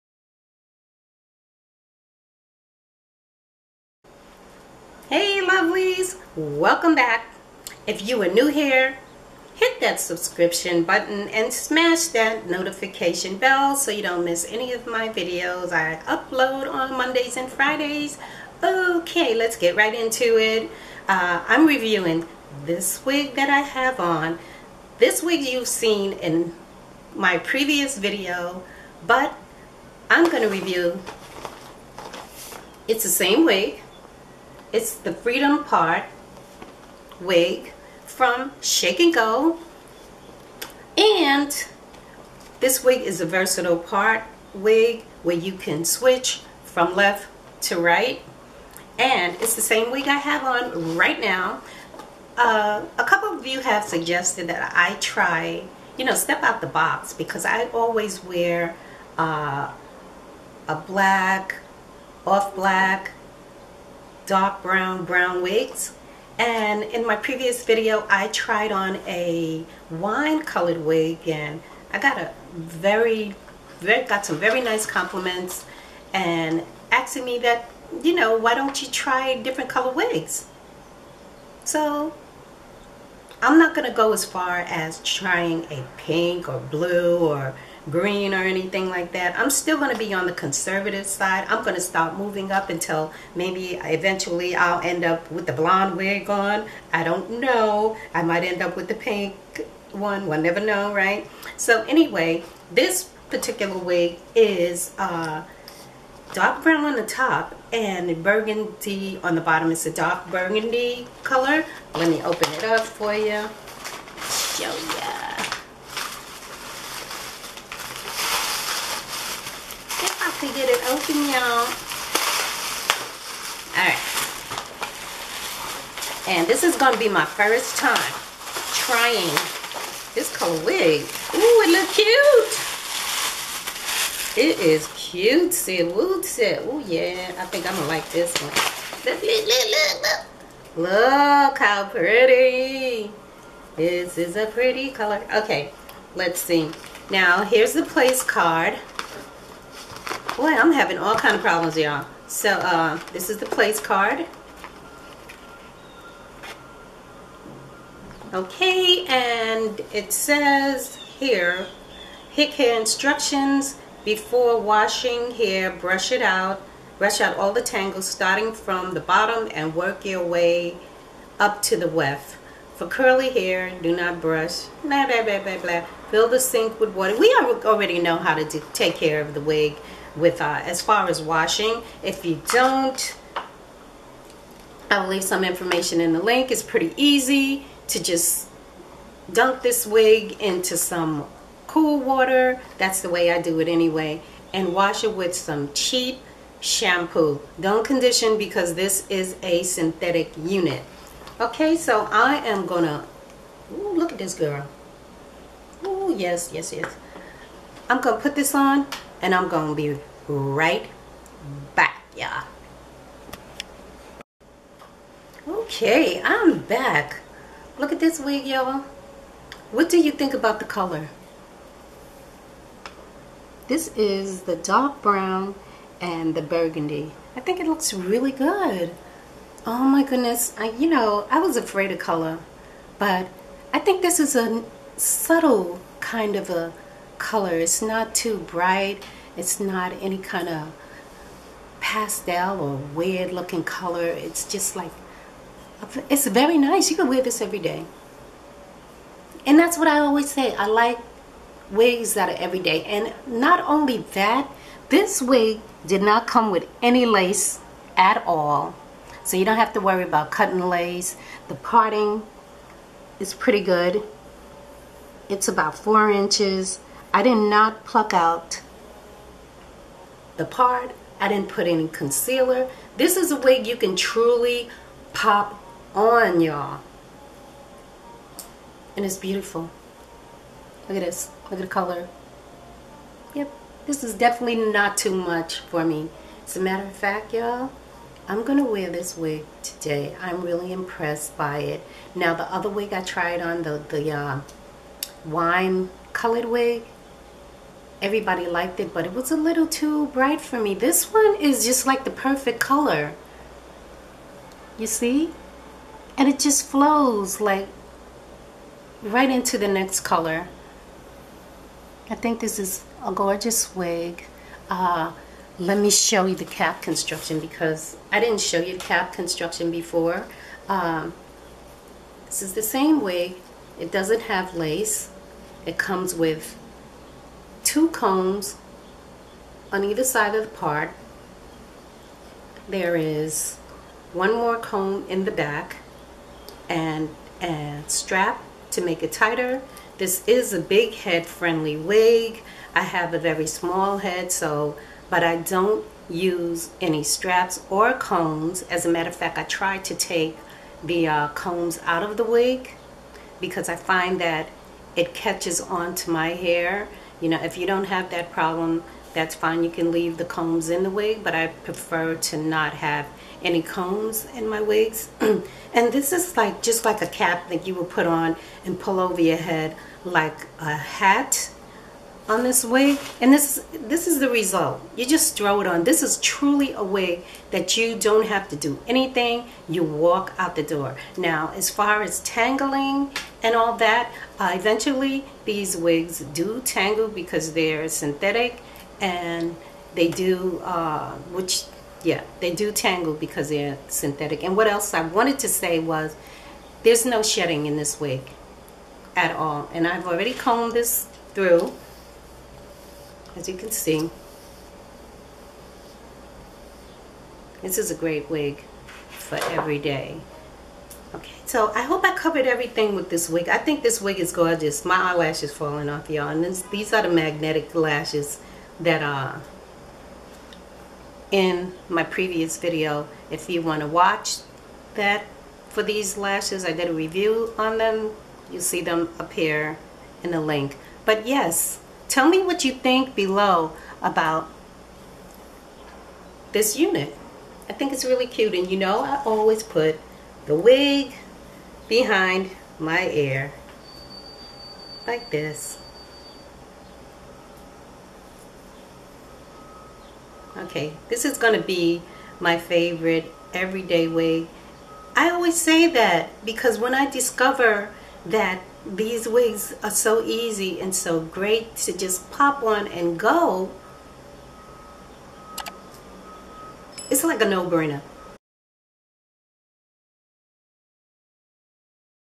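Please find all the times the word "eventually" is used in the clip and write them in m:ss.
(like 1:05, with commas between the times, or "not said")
1:33, 6:24.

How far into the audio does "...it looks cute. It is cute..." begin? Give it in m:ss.
2:11.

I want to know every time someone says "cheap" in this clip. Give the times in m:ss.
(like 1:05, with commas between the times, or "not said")
3:15.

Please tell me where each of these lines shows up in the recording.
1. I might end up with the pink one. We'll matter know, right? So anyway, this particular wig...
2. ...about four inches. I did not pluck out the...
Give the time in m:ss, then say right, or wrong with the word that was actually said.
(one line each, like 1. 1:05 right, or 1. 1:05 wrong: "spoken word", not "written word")
1. 1:38 wrong: "never", not "matter"
2. 4:25 right.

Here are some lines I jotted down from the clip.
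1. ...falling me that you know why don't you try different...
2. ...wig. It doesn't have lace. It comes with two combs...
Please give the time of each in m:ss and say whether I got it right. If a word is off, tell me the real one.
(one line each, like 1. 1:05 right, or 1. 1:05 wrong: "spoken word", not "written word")
1. 1:16 wrong: "asking", not "falling"
2. 5:23 right.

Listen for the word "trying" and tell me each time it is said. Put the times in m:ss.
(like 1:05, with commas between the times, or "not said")
1:25, 2:08.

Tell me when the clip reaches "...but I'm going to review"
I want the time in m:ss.
0:29.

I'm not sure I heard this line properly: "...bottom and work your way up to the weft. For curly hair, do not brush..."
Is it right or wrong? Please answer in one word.
right.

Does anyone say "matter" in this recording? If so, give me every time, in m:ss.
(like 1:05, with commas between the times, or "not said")
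4:46, 5:48.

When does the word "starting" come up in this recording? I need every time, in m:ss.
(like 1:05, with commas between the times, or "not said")
2:48.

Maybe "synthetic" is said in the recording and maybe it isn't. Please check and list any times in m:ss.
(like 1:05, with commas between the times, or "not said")
3:19, 6:27, 6:33.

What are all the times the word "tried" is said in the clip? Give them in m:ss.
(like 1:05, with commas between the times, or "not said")
1:08, 4:53.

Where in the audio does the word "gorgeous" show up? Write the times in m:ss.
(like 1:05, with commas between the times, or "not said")
5:13, 6:54.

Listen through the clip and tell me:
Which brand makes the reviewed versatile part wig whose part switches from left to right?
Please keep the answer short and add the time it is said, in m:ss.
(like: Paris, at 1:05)
Shake and Go, at 0:38.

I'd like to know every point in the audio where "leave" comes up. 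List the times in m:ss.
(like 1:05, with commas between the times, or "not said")
3:05, 5:59.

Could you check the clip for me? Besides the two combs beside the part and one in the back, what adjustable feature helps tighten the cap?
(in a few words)
A strap.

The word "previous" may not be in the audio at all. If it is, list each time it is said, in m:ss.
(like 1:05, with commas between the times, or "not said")
0:27, 1:07, 7:02.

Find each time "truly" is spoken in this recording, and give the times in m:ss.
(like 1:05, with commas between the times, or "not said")
4:33, 6:16.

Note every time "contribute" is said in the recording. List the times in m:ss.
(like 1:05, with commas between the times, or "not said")
not said.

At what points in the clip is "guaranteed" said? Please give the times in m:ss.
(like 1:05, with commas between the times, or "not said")
not said.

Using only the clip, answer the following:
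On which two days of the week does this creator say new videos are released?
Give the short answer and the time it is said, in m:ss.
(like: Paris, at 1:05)
Mondays and Fridays, at 0:16.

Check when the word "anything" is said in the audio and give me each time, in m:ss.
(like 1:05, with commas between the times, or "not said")
1:28, 6:18.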